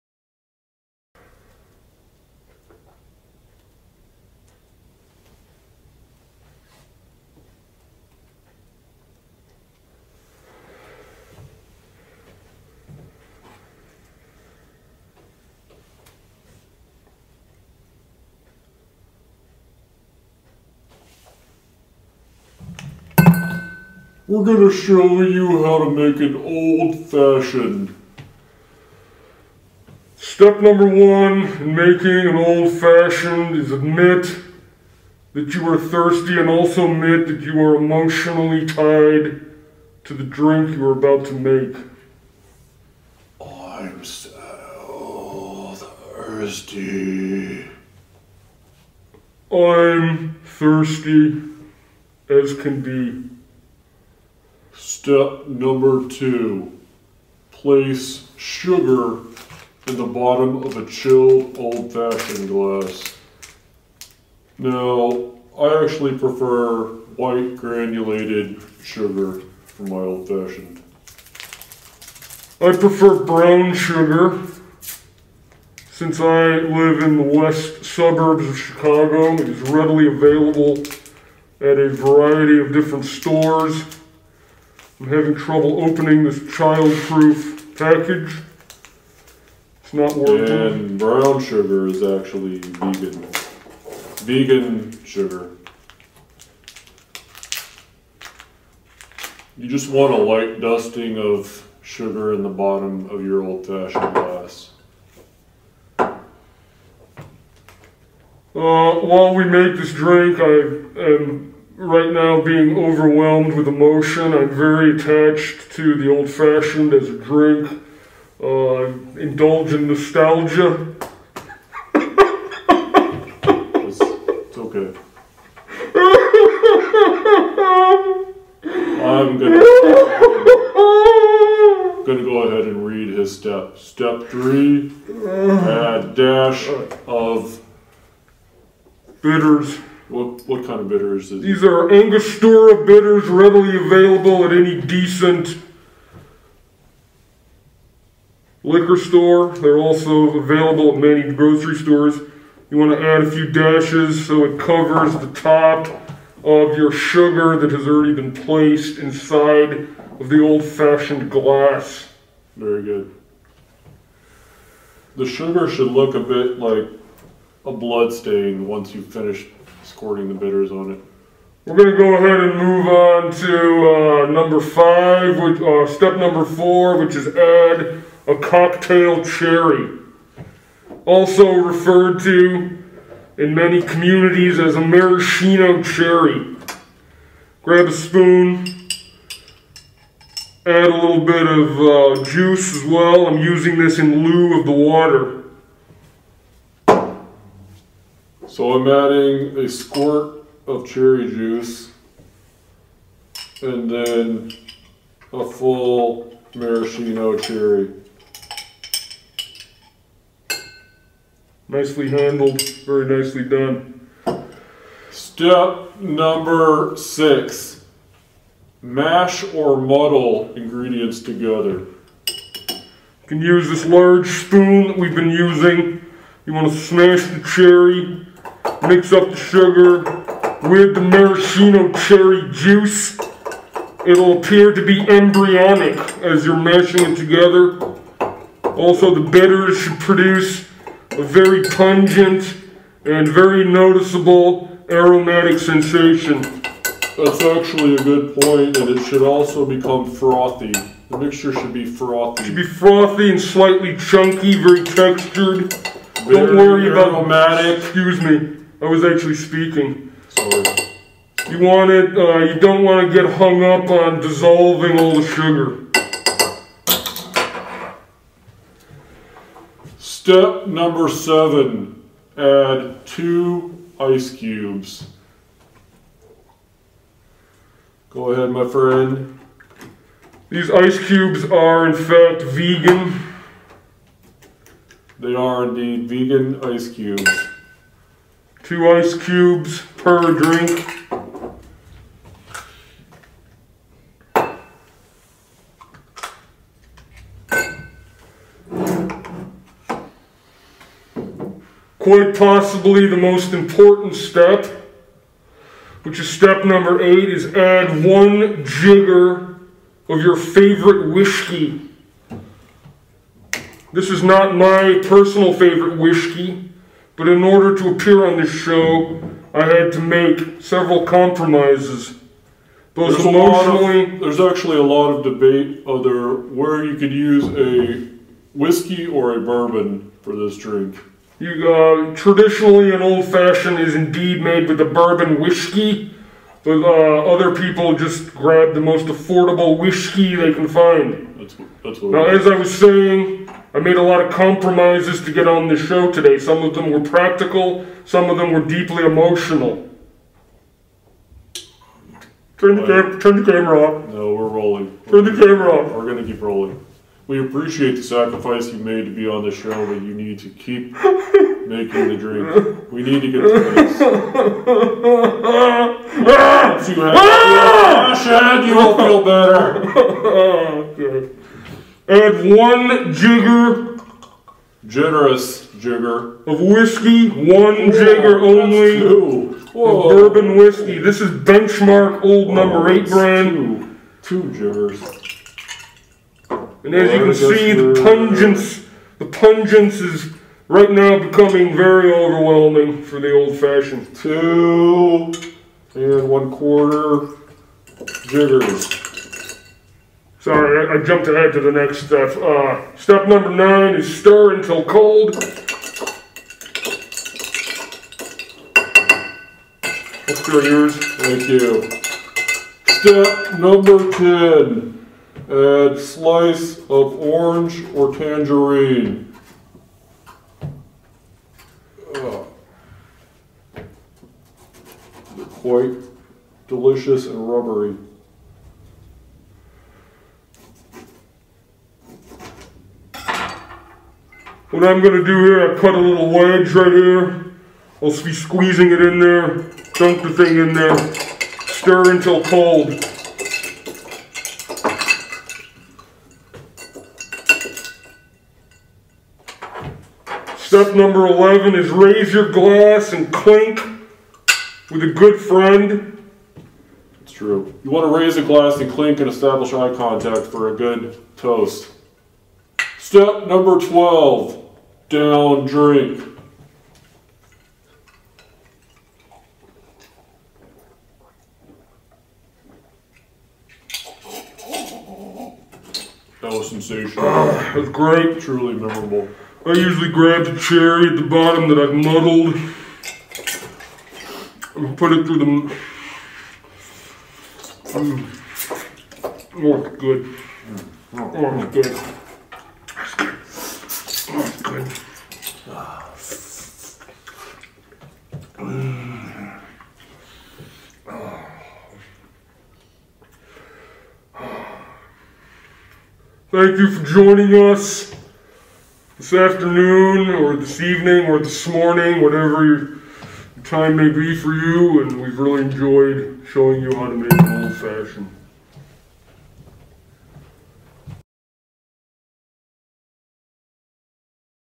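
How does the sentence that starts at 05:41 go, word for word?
That's that's what now, as I was saying, I made a lot of compromises to get on the show today.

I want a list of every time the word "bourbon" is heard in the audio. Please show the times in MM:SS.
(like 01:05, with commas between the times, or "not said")
05:29, 05:34, 06:19.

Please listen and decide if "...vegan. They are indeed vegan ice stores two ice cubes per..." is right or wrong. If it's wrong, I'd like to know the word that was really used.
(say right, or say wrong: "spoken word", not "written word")
wrong: "cubes", not "stores".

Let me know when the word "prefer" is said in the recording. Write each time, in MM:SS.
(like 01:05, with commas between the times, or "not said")
01:06, 01:12.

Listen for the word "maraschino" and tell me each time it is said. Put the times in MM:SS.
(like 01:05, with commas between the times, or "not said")
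03:04, 03:26, 03:51.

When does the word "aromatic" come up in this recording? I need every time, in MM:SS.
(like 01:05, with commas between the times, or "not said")
04:04, 04:16.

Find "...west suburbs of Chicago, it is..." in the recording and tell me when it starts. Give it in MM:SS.
01:17.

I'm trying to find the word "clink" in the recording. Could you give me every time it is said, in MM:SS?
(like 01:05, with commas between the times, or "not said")
07:33, 07:38.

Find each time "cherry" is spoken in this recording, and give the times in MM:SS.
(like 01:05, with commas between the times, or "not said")
02:59, 03:05, 03:20, 03:27, 03:47, 03:51, 08:00.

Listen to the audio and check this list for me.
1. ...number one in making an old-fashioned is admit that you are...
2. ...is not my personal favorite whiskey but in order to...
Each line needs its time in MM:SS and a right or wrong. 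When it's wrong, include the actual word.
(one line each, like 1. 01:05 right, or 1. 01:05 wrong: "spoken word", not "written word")
1. 00:30 right
2. 05:14 right.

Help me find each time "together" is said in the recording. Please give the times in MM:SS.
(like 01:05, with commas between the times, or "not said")
03:41, 03:57.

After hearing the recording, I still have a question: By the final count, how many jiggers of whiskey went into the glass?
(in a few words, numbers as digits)
2 and 1/4.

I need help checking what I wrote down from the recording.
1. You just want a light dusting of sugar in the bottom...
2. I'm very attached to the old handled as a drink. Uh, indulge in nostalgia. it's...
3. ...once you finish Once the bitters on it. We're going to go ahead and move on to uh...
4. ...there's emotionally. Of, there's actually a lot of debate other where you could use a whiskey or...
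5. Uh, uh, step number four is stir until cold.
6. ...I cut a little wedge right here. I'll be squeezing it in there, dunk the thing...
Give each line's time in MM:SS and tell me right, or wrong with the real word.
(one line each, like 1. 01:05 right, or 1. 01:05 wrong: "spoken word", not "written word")
1. 01:39 right
2. 01:54 wrong: "fashioned", not "handled"
3. 02:48 wrong: "Scoring", not "Once"
4. 05:23 right
5. 06:42 wrong: "nine", not "four"
6. 07:15 right.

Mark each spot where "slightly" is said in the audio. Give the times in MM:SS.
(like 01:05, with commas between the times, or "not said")
04:13.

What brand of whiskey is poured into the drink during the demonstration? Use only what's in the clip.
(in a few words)
Benchmark.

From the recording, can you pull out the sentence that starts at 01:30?
And brown sugar is actually vegan.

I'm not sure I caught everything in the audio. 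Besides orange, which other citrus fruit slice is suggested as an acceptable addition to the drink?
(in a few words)
tangerine.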